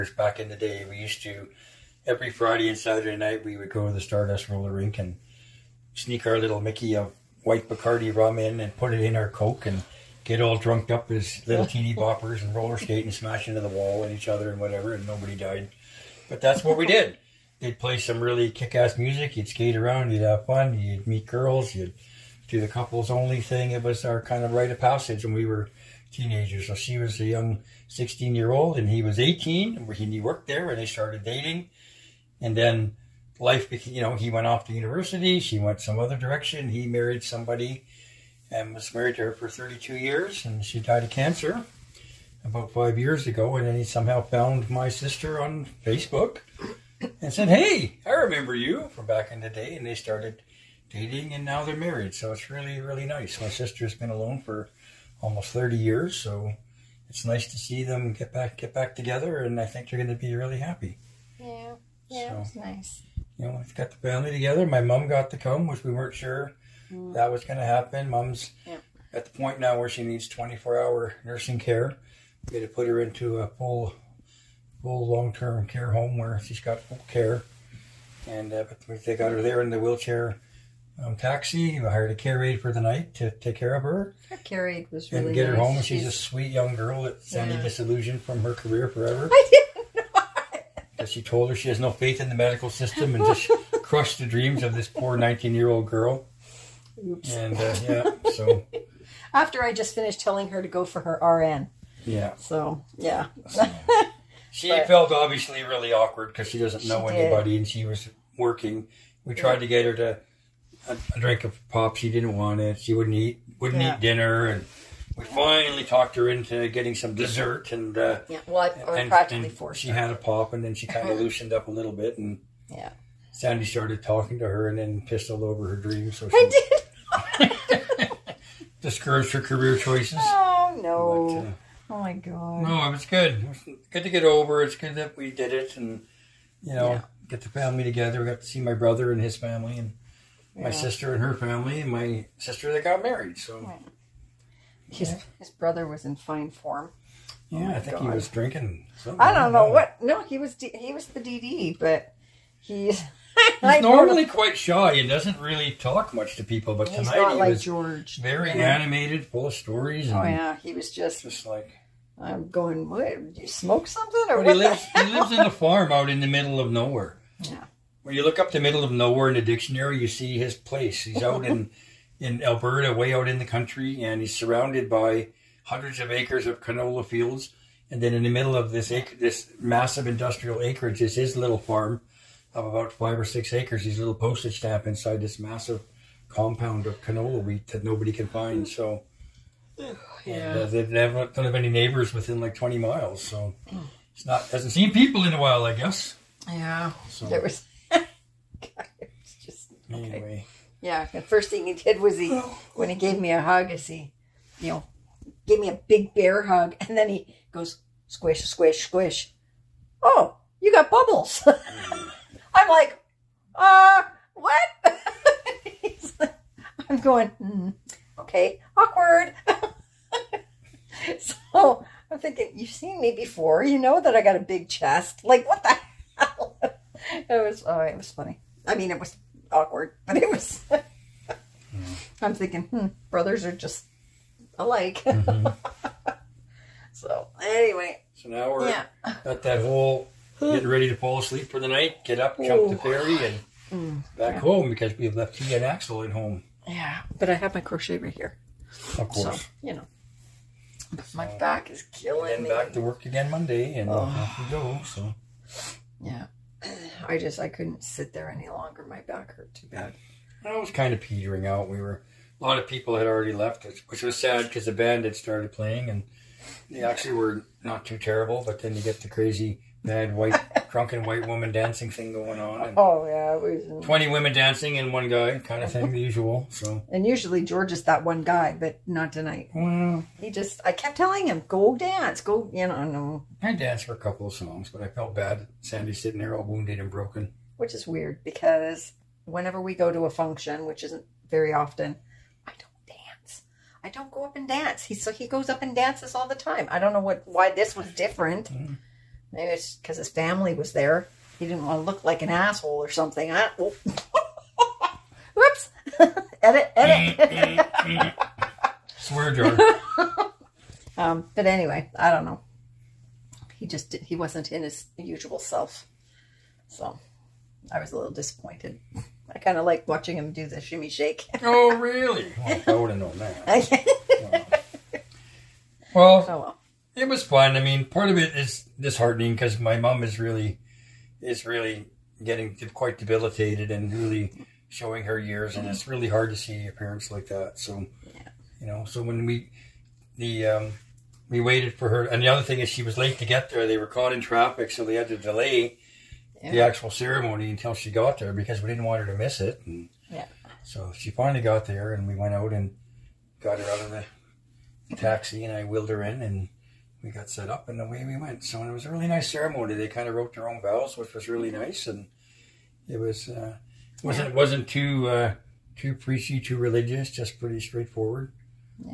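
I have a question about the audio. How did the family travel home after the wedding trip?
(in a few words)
the ferry.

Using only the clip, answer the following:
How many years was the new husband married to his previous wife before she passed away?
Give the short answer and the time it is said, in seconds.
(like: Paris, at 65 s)
32, at 39 s.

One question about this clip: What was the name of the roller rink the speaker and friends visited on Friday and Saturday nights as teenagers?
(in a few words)
Stardust Roller Rink.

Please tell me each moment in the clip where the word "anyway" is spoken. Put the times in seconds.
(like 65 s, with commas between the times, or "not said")
200 s, 237 s, 311 s.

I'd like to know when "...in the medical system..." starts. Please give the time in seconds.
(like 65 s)
92 s.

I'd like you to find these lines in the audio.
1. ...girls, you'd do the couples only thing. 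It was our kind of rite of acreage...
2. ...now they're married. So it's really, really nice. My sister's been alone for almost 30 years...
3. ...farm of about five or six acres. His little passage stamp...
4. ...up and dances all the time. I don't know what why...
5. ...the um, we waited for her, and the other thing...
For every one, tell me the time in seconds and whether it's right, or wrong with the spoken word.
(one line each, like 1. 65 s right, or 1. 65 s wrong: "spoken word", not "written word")
1. 21 s wrong: "passage", not "acreage"
2. 51 s right
3. 181 s wrong: "postage", not "passage"
4. 295 s right
5. 340 s right.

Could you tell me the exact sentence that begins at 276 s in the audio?
So and usually George is that one guy, but not tonight.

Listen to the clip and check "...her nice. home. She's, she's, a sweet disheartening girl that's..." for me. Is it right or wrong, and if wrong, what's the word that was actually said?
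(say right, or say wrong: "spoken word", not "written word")
wrong: "young", not "disheartening".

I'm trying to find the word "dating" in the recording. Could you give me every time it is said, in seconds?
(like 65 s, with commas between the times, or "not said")
31 s, 50 s.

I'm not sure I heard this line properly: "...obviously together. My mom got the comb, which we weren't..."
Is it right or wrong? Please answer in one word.
wrong.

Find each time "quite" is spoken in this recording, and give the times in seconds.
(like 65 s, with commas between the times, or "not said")
154 s, 332 s.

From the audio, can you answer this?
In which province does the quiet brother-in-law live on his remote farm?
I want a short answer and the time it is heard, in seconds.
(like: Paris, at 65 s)
Alberta, at 172 s.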